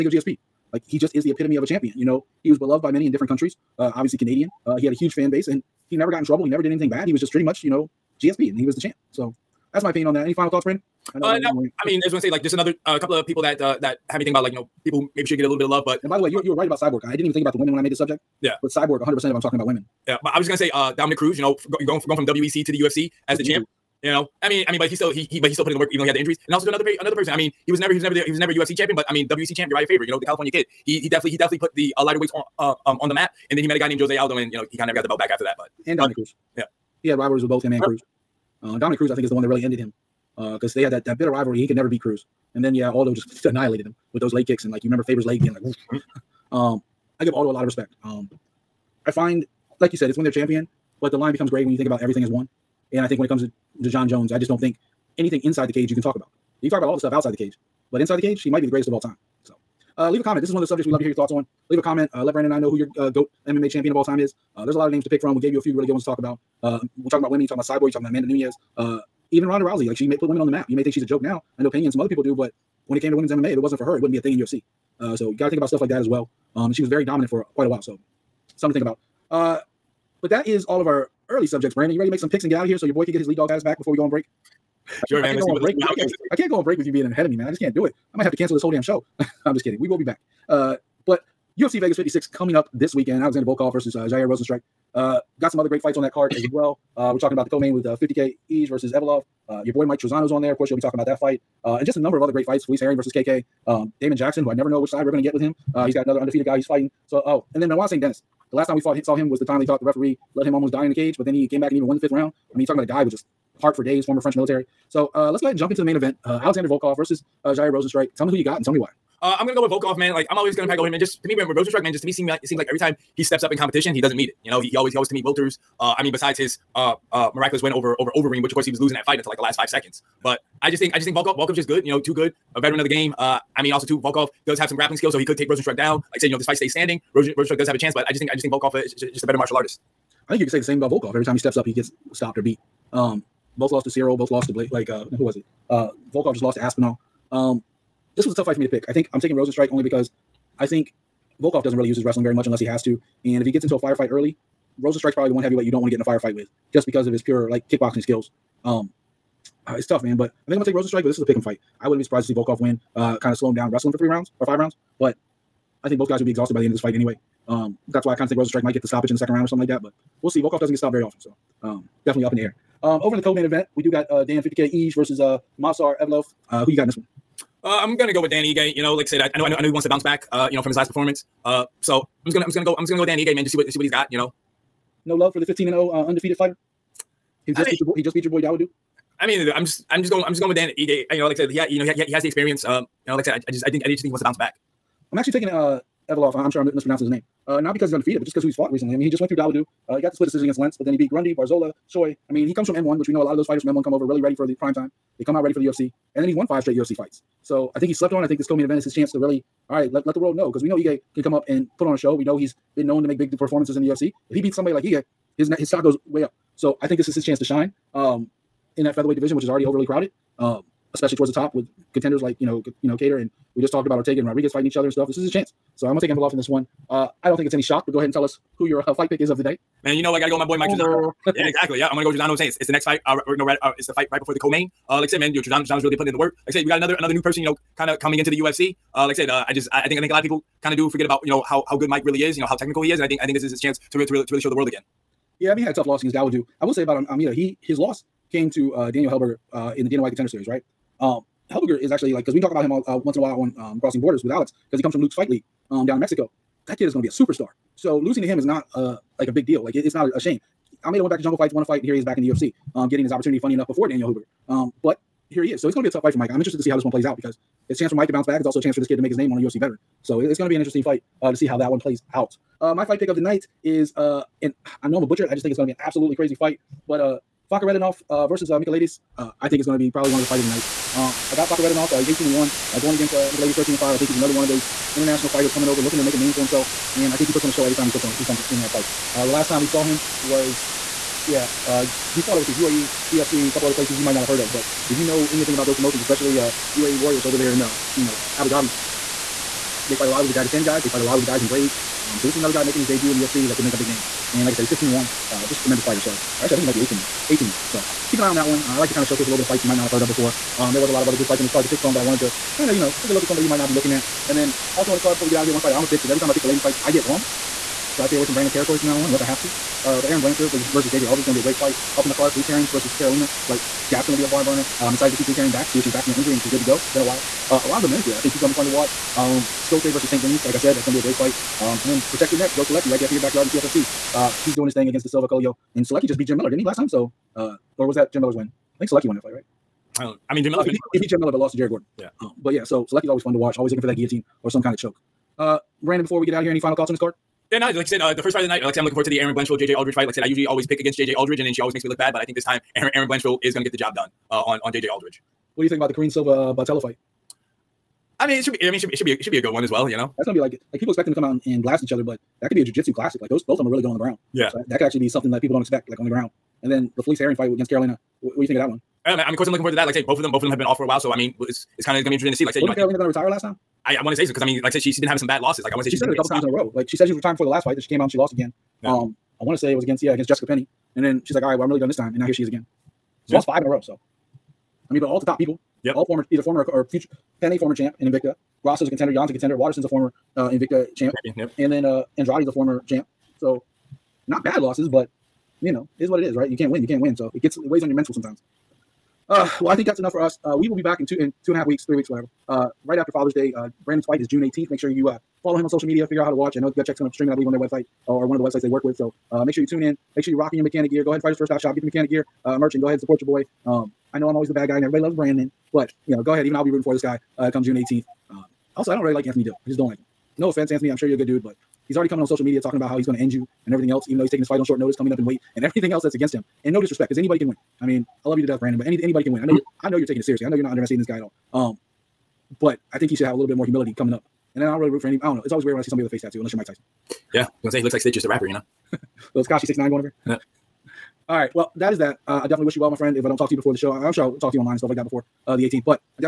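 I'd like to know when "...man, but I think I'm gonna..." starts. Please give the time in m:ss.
2:40.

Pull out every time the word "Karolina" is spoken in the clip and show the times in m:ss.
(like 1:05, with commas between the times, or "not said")
5:22, 6:07, 6:12.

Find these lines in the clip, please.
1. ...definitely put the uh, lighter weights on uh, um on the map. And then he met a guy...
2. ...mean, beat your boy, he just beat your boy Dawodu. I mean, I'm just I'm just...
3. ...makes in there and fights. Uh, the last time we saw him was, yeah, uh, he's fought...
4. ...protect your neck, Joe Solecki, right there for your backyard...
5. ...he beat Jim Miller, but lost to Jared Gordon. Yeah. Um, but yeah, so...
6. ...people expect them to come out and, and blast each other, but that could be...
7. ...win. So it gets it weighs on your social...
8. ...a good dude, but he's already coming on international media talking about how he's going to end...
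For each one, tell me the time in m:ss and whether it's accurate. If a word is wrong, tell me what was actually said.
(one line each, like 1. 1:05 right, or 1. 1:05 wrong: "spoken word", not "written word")
1. 0:31 right
2. 3:07 right
3. 4:48 wrong: "comes", not "makes"
4. 5:32 right
5. 5:40 right
6. 6:00 right
7. 6:36 wrong: "mental", not "social"
8. 7:01 wrong: "social", not "international".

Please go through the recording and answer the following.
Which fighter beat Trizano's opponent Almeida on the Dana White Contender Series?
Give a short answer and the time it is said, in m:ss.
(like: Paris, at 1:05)
Daniel Zellhuber, at 4:08.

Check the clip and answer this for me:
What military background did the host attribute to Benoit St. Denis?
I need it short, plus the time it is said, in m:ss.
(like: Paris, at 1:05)
French military, at 1:54.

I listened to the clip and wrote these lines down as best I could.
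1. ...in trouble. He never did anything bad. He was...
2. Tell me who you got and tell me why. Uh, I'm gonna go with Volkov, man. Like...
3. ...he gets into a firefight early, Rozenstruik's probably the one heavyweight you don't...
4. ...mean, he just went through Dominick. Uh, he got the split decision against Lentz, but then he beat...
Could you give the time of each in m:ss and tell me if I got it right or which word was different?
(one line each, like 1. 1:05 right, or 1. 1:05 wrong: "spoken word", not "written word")
1. 0:06 right
2. 1:58 right
3. 2:33 right
4. 3:18 wrong: "Dawodu", not "Dominick".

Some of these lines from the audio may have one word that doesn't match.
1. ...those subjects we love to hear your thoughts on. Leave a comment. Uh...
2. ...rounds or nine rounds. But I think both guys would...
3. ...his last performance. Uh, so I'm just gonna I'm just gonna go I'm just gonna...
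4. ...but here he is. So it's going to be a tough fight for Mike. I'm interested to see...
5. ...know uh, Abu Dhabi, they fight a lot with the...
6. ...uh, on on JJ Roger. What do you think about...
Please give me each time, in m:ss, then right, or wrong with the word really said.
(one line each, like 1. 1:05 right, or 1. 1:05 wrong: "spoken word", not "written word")
1. 1:00 right
2. 2:44 wrong: "five", not "nine"
3. 3:00 right
4. 4:24 right
5. 4:58 right
6. 5:54 wrong: "Aldrich", not "Roger".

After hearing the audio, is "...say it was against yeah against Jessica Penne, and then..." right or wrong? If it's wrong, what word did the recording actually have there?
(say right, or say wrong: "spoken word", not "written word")
right.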